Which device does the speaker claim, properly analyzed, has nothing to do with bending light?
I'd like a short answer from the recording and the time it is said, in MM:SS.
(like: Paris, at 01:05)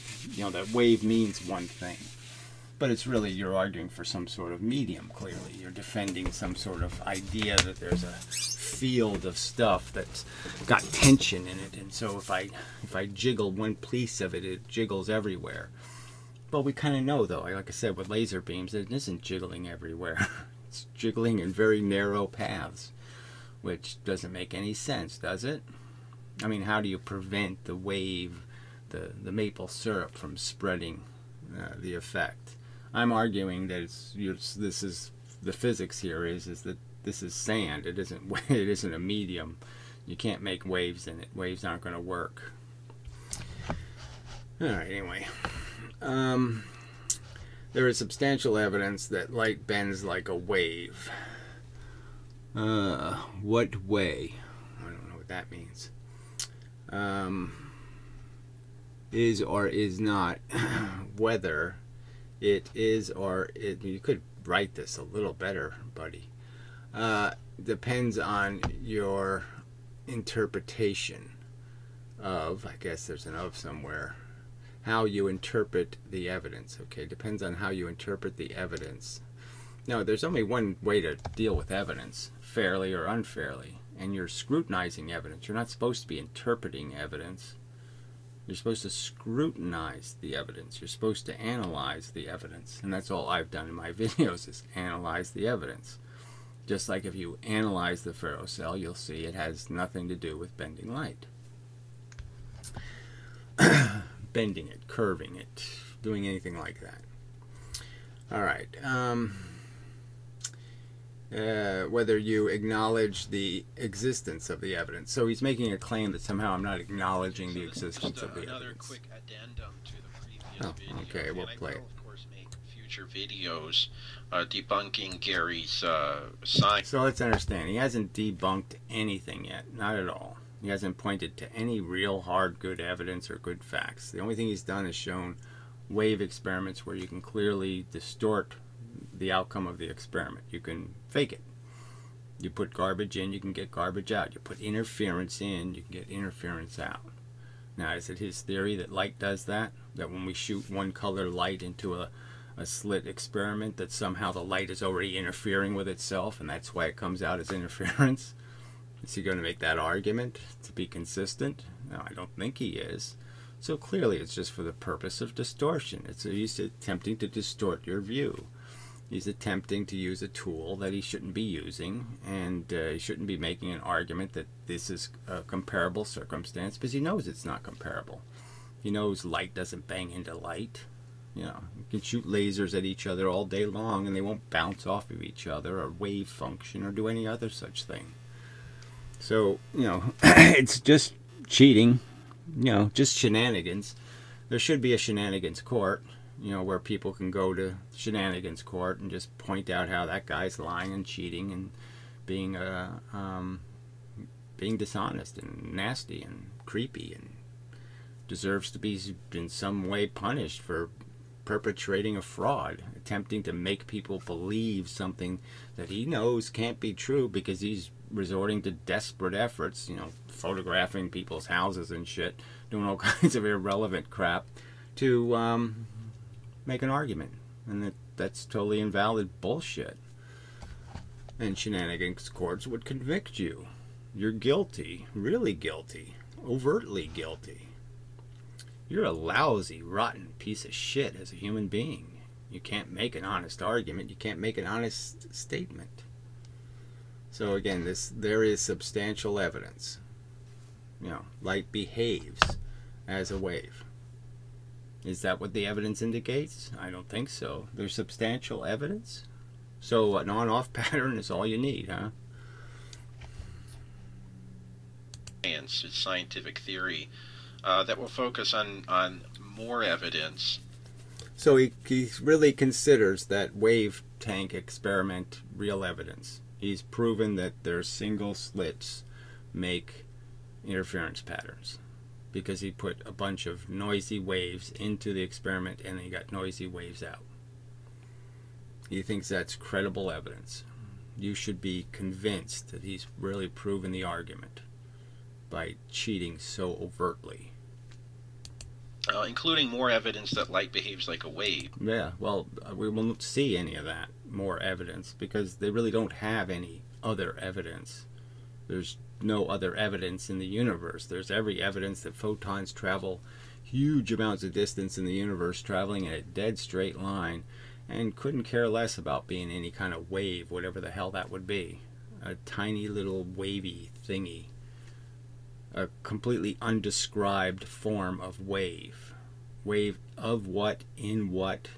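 ferrocell, at 01:38.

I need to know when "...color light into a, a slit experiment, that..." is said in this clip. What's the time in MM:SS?
02:30.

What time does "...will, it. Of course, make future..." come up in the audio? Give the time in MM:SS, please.
02:01.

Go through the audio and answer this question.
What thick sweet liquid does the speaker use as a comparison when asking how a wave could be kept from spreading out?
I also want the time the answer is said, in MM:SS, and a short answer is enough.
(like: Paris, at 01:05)
maple syrup, at 00:29.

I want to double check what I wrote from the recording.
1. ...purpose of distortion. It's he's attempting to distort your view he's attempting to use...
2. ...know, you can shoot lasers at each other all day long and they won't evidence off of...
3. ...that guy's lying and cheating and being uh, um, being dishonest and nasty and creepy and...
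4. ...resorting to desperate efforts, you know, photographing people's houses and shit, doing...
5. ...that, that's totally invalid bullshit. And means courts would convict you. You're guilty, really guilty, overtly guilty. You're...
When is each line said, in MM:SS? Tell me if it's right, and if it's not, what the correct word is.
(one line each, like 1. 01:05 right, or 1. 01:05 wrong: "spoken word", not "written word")
1. 02:44 right
2. 03:01 wrong: "bounce", not "evidence"
3. 03:20 right
4. 03:38 right
5. 03:47 wrong: "shenanigans", not "means".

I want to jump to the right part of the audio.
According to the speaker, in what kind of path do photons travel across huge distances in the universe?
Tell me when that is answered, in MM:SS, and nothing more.
05:16.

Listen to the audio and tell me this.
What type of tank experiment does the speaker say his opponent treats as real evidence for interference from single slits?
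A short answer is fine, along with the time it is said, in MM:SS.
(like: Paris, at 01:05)
wave tank, at 04:33.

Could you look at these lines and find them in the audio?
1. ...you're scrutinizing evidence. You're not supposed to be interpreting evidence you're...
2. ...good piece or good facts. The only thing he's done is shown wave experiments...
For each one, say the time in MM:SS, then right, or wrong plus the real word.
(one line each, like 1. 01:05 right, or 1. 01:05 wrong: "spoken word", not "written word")
1. 01:24 right
2. 02:12 wrong: "evidence", not "piece".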